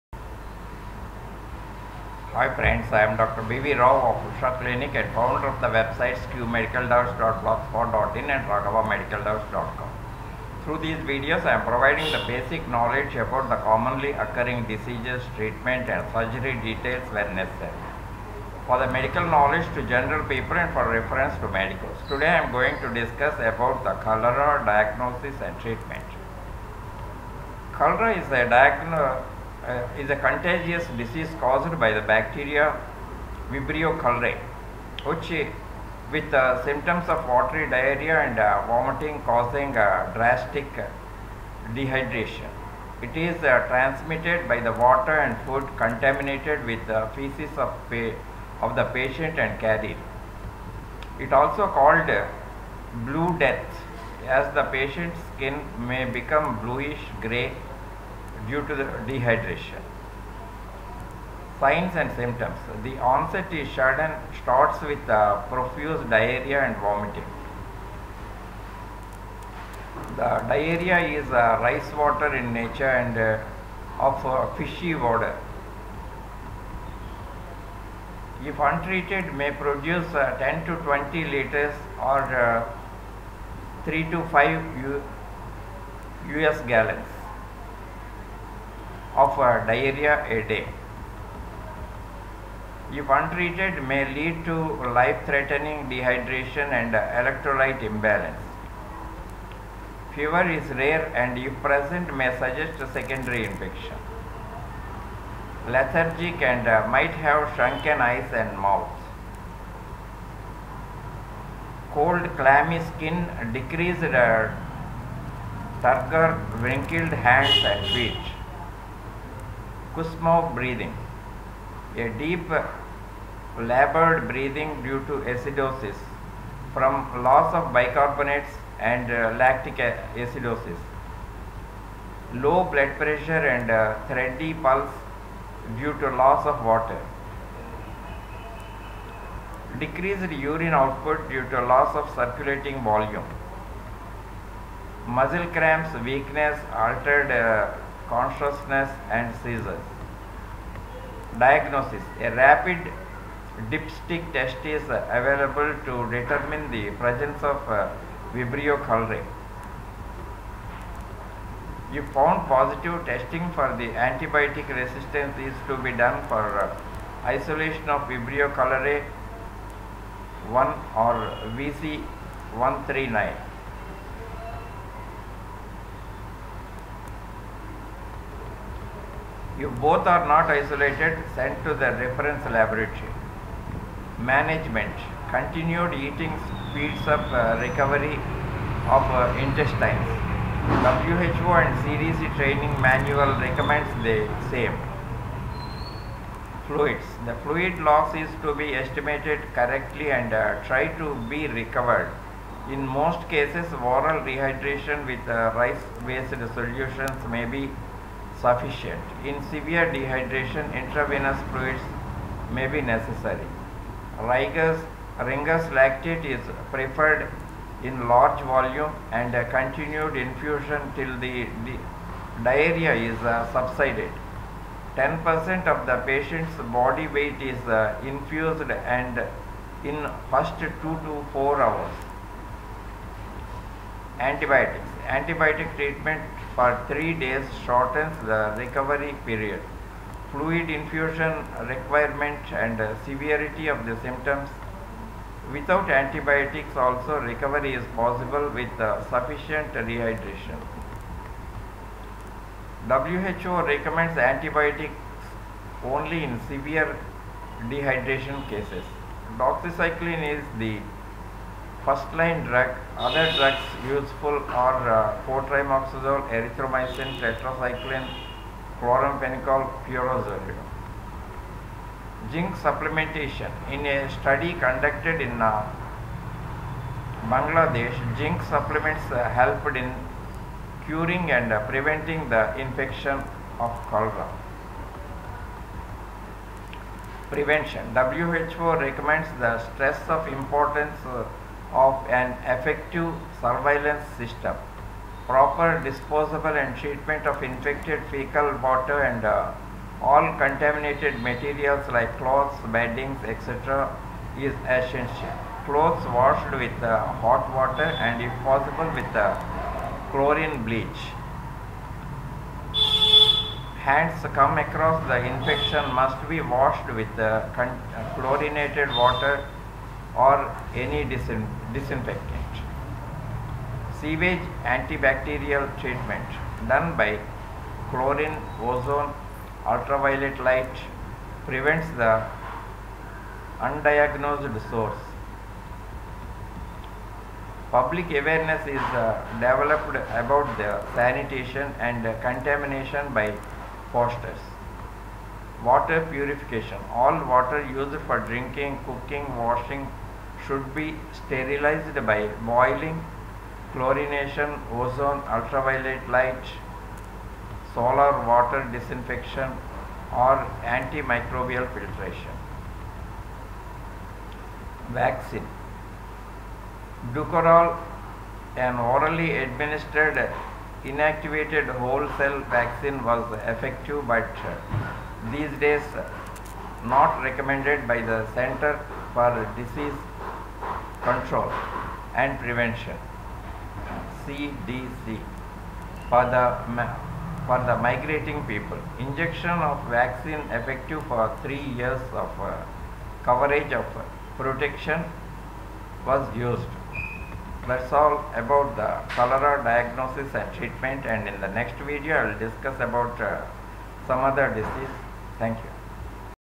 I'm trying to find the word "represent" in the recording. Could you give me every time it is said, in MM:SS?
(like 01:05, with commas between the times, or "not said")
not said.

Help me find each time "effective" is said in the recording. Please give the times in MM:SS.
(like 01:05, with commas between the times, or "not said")
04:52, 06:13, 06:30.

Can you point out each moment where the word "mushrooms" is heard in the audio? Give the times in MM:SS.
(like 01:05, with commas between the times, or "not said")
not said.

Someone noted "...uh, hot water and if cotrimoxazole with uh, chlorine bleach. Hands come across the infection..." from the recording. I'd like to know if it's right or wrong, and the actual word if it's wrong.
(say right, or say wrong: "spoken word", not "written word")
wrong: "possible", not "cotrimoxazole".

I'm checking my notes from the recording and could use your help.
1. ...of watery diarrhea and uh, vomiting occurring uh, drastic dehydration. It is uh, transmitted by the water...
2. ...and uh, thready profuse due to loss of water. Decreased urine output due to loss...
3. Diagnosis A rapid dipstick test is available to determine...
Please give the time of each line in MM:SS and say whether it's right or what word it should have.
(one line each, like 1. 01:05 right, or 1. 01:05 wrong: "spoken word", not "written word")
1. 00:37 wrong: "causing", not "occurring"
2. 02:13 wrong: "pulse", not "profuse"
3. 02:31 right.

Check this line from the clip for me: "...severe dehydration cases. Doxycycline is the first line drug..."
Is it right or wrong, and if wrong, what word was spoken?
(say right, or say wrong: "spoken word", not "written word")
right.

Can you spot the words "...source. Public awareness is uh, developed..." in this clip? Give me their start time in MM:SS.
05:34.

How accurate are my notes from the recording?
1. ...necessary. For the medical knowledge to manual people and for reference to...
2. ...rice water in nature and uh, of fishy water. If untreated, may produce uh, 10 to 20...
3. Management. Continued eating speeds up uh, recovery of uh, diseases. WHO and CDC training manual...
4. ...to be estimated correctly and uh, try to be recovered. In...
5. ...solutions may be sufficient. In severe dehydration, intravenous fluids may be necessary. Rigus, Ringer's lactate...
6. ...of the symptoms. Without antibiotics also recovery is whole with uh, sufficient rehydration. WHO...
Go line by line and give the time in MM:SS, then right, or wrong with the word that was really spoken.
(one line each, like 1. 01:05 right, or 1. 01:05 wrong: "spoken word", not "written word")
1. 00:17 wrong: "general", not "manual"
2. 01:11 right
3. 03:04 wrong: "intestines", not "diseases"
4. 03:18 right
5. 03:26 right
6. 04:03 wrong: "possible", not "whole".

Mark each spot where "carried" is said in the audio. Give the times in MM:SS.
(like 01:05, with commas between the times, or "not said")
00:49.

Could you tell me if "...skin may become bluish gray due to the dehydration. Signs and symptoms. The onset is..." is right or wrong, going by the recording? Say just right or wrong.
right.